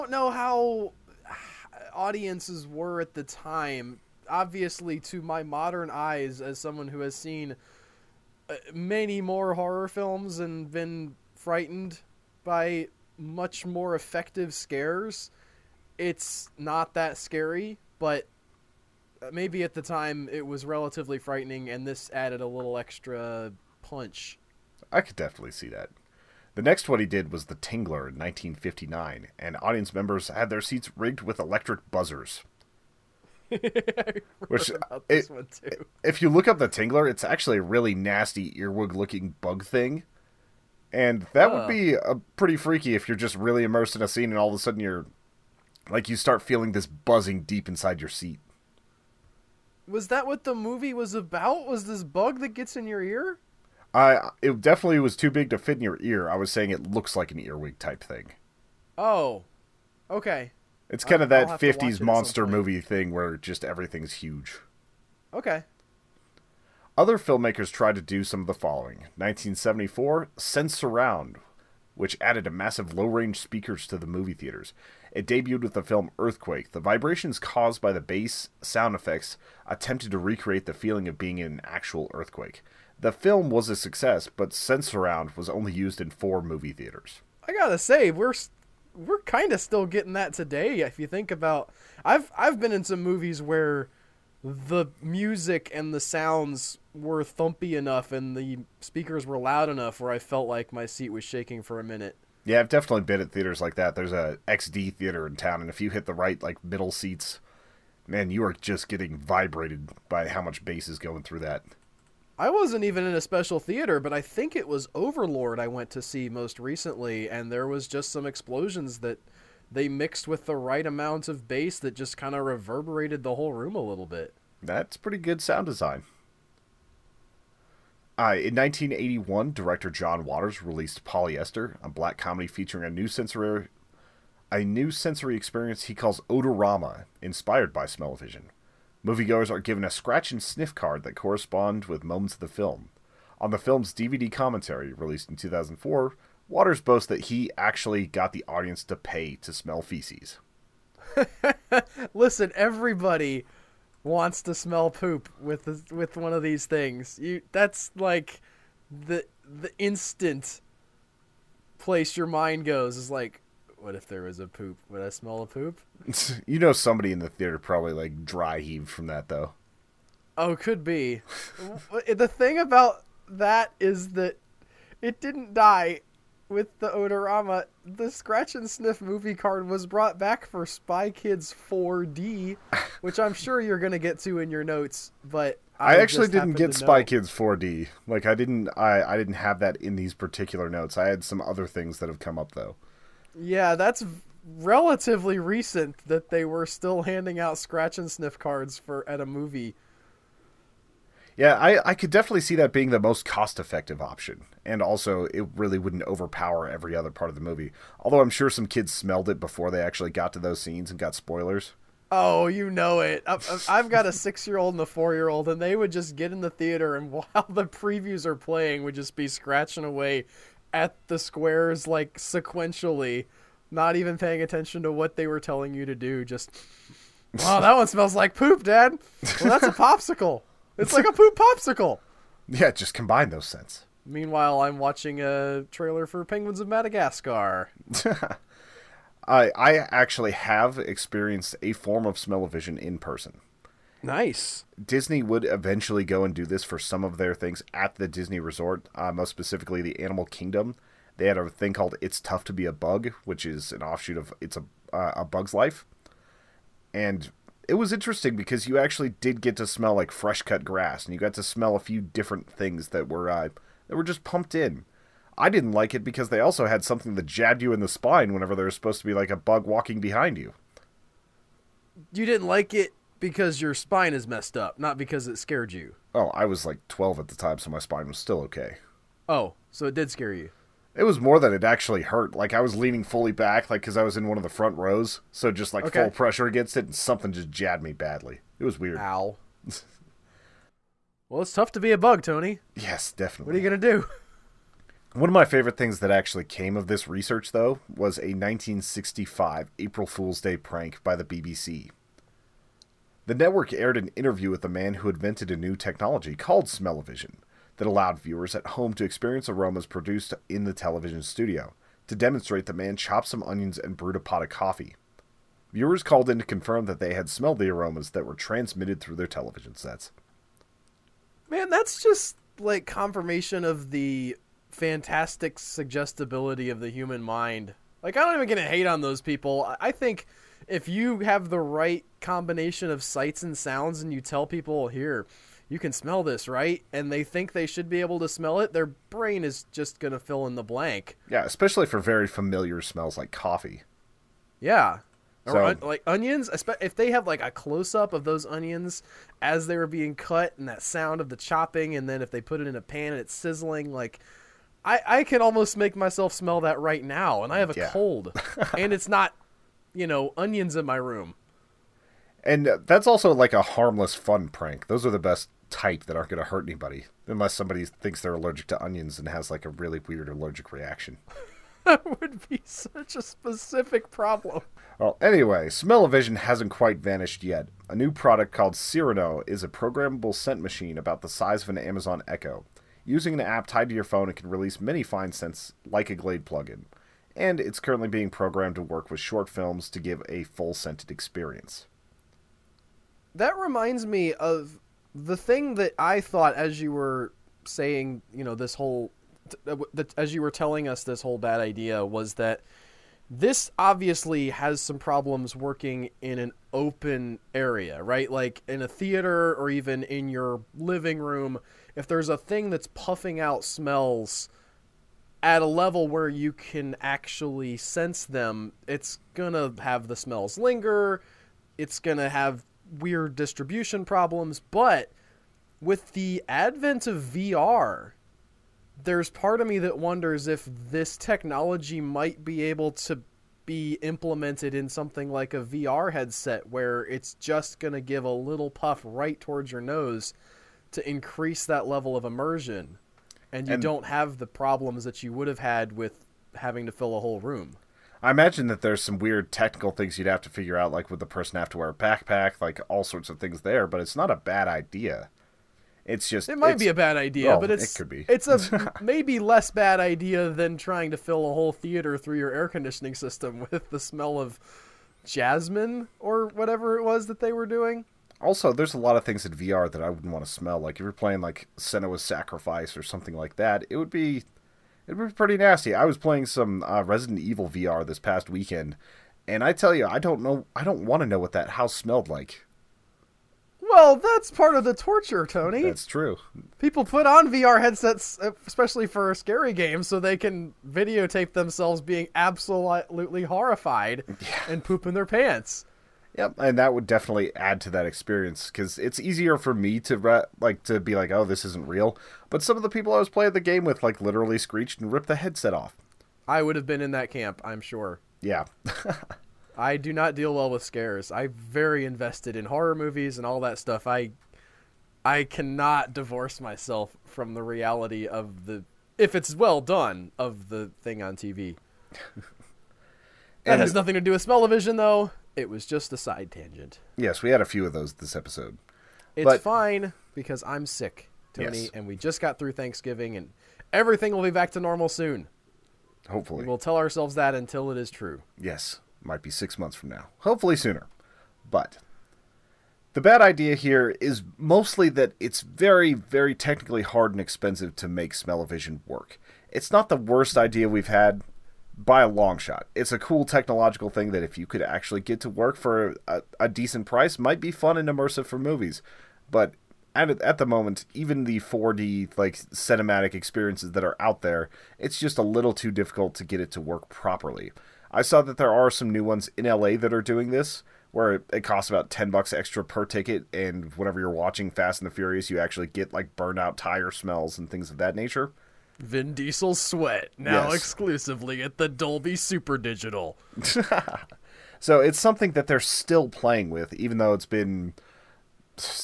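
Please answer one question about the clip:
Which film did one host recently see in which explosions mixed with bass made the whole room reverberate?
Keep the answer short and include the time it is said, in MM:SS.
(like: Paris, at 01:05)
Overlord, at 01:54.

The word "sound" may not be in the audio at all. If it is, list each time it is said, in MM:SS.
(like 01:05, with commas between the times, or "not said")
01:18, 01:35, 02:05, 05:33, 05:50.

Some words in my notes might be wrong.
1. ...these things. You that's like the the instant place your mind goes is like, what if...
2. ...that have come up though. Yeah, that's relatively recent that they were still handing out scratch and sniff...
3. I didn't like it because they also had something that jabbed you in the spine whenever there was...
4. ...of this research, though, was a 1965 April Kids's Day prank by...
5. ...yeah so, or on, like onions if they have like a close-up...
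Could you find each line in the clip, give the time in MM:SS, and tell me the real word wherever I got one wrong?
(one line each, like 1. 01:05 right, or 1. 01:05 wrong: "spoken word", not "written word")
1. 02:36 right
2. 03:11 right
3. 04:25 right
4. 04:56 wrong: "Fool", not "Kids"
5. 05:44 right.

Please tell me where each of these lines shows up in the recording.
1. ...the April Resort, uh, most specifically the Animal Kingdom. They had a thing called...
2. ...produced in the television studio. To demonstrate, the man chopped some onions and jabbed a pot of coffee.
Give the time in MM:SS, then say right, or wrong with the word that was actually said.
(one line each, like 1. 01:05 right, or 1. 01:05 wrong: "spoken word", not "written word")
1. 04:07 wrong: "Disney", not "April"
2. 05:09 wrong: "brewed", not "jabbed".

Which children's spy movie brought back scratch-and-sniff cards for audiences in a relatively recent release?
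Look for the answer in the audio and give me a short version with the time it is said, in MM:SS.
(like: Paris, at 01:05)
Spy Kids 4D, at 03:00.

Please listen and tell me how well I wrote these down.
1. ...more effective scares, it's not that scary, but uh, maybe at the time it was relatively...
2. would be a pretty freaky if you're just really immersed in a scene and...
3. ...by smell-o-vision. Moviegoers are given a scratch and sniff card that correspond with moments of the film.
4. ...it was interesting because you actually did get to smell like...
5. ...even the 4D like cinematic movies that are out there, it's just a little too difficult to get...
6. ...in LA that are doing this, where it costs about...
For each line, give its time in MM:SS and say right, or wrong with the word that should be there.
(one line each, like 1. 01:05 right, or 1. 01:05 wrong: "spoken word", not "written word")
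1. 00:13 right
2. 00:41 right
3. 02:17 right
4. 04:17 right
5. 09:21 wrong: "experiences", not "movies"
6. 09:29 right.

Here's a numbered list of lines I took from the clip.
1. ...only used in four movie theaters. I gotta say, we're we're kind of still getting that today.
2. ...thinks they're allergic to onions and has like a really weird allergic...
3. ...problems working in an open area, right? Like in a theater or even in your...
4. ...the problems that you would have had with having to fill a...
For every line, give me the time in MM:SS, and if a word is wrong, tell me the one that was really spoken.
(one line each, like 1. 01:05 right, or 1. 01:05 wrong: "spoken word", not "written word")
1. 01:25 right
2. 06:07 right
3. 06:44 right
4. 07:24 right.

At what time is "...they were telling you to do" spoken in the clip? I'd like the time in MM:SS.
03:45.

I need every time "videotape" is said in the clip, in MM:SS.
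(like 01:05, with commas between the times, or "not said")
08:10.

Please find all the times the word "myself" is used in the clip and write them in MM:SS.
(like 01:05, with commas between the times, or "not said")
05:55, 08:36.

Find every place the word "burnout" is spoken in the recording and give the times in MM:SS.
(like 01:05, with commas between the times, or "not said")
09:36.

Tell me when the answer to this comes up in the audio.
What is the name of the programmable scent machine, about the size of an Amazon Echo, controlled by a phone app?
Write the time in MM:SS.
06:18.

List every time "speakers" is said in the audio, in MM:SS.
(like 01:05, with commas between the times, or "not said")
01:13, 01:38.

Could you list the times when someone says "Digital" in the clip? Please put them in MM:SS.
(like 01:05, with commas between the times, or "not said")
09:42.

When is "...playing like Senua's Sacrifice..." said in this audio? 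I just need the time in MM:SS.
07:51.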